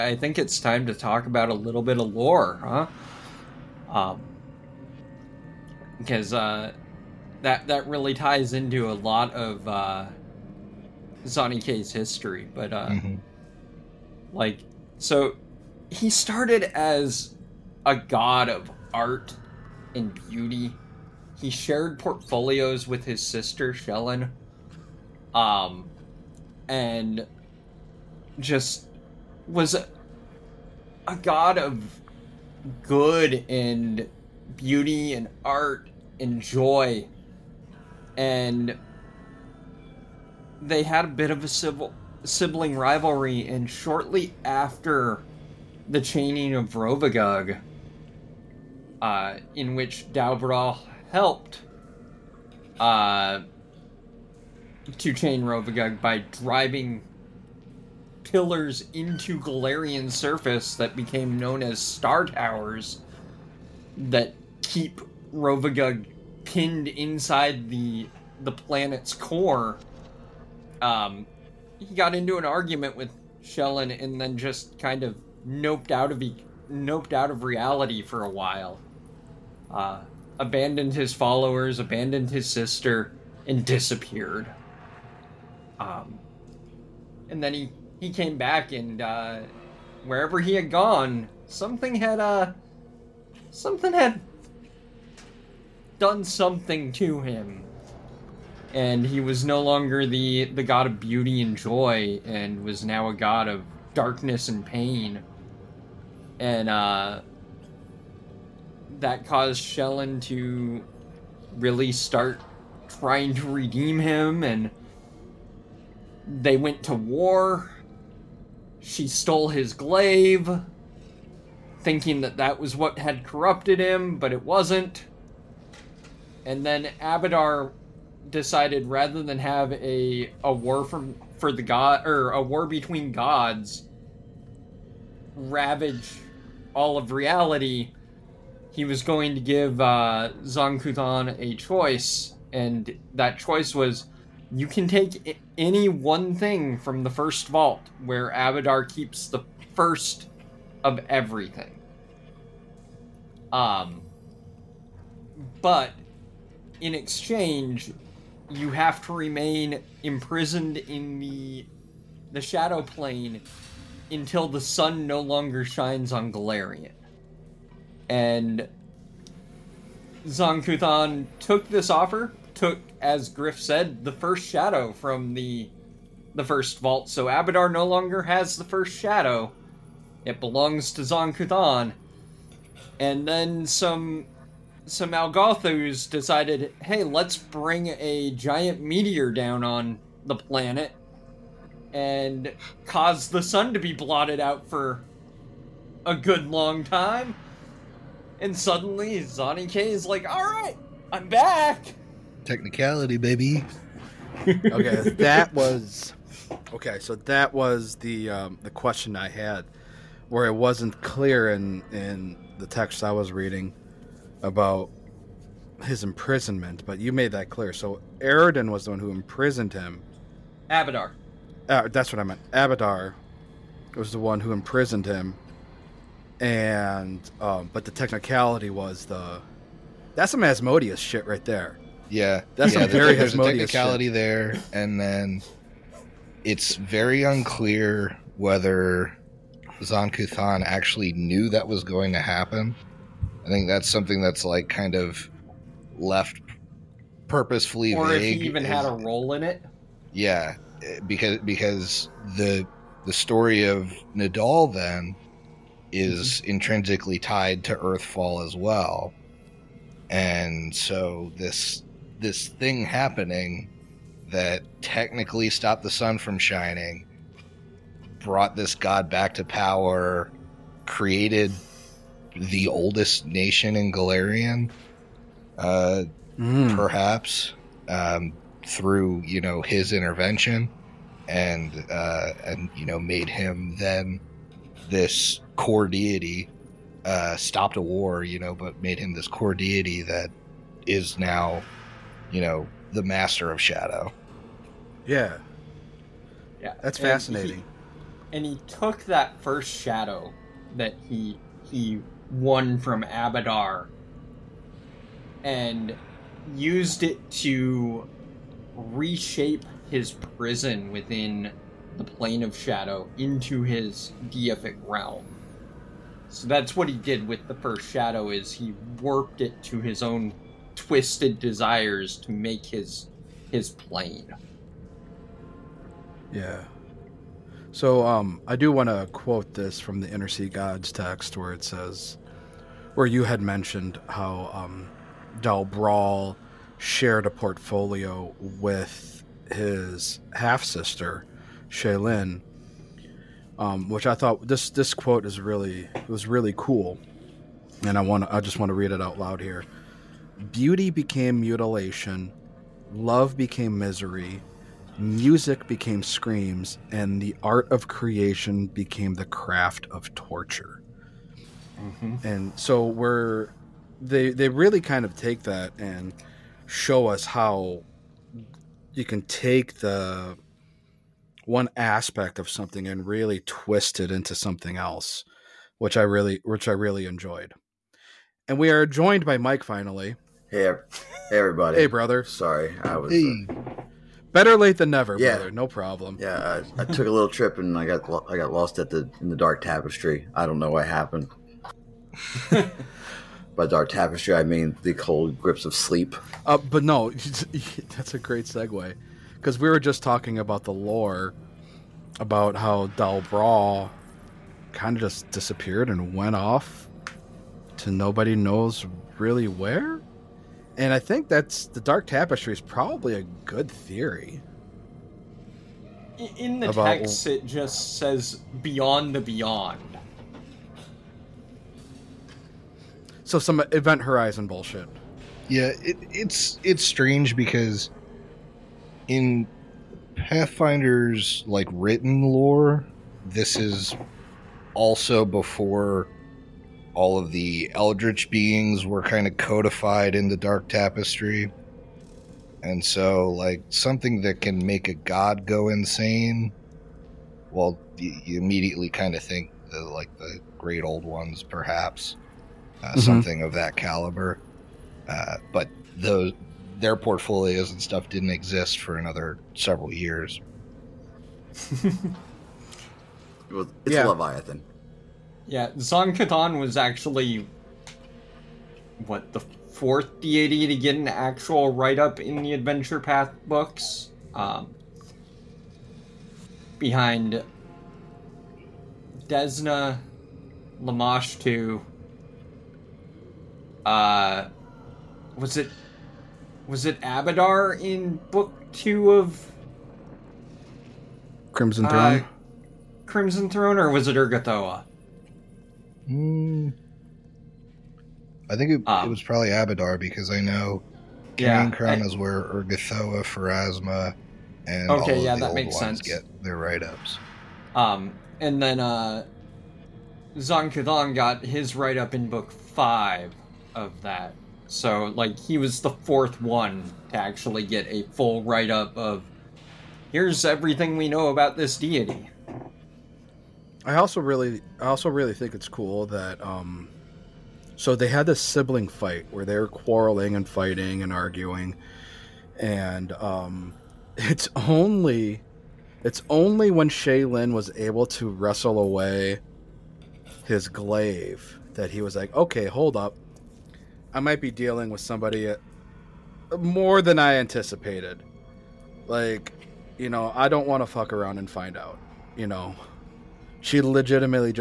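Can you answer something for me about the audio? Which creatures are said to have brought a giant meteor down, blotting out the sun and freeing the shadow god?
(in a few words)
Alghollthus.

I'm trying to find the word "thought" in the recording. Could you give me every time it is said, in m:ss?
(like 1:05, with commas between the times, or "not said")
5:44.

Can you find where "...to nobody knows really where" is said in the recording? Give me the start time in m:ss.
6:47.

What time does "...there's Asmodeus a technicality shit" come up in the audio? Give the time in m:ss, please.
3:53.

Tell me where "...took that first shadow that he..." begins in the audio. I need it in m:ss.
4:58.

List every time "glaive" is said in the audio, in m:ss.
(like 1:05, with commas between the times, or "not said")
1:59, 9:00.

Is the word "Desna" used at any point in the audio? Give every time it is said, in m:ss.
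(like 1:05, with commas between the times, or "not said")
7:59.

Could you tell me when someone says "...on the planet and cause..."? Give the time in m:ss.
3:09.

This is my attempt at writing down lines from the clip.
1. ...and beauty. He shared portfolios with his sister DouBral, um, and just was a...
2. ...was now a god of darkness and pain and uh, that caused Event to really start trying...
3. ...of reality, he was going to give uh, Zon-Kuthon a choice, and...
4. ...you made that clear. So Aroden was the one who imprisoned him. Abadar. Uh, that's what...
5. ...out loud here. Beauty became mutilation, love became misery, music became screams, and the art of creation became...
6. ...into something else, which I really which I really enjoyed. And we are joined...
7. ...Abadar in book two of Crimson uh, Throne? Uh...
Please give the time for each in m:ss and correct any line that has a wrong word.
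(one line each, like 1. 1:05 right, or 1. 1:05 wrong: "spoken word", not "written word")
1. 0:19 wrong: "Shelyn", not "DouBral"
2. 1:42 wrong: "Shelyn", not "Event"
3. 2:16 right
4. 3:36 right
5. 5:49 right
6. 6:14 right
7. 8:07 right.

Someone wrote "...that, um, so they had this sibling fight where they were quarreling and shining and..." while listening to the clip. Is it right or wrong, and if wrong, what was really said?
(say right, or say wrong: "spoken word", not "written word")
wrong: "fighting", not "shining".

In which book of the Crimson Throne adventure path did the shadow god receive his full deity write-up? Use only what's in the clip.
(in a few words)
Book 5.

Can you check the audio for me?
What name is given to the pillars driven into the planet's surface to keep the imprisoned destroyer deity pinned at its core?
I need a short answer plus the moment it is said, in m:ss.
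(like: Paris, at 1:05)
Star Towers, at 1:01.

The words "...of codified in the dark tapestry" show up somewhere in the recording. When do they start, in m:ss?
7:19.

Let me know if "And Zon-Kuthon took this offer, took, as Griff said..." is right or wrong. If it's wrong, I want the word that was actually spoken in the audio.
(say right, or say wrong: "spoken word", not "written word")
right.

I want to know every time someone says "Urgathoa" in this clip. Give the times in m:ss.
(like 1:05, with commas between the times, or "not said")
8:14, 8:22.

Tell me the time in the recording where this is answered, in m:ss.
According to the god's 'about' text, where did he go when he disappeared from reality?
6:58.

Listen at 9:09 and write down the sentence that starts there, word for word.
Like, you know, I don't want to fuck around and find out.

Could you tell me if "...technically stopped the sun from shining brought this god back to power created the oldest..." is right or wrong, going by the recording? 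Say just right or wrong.
right.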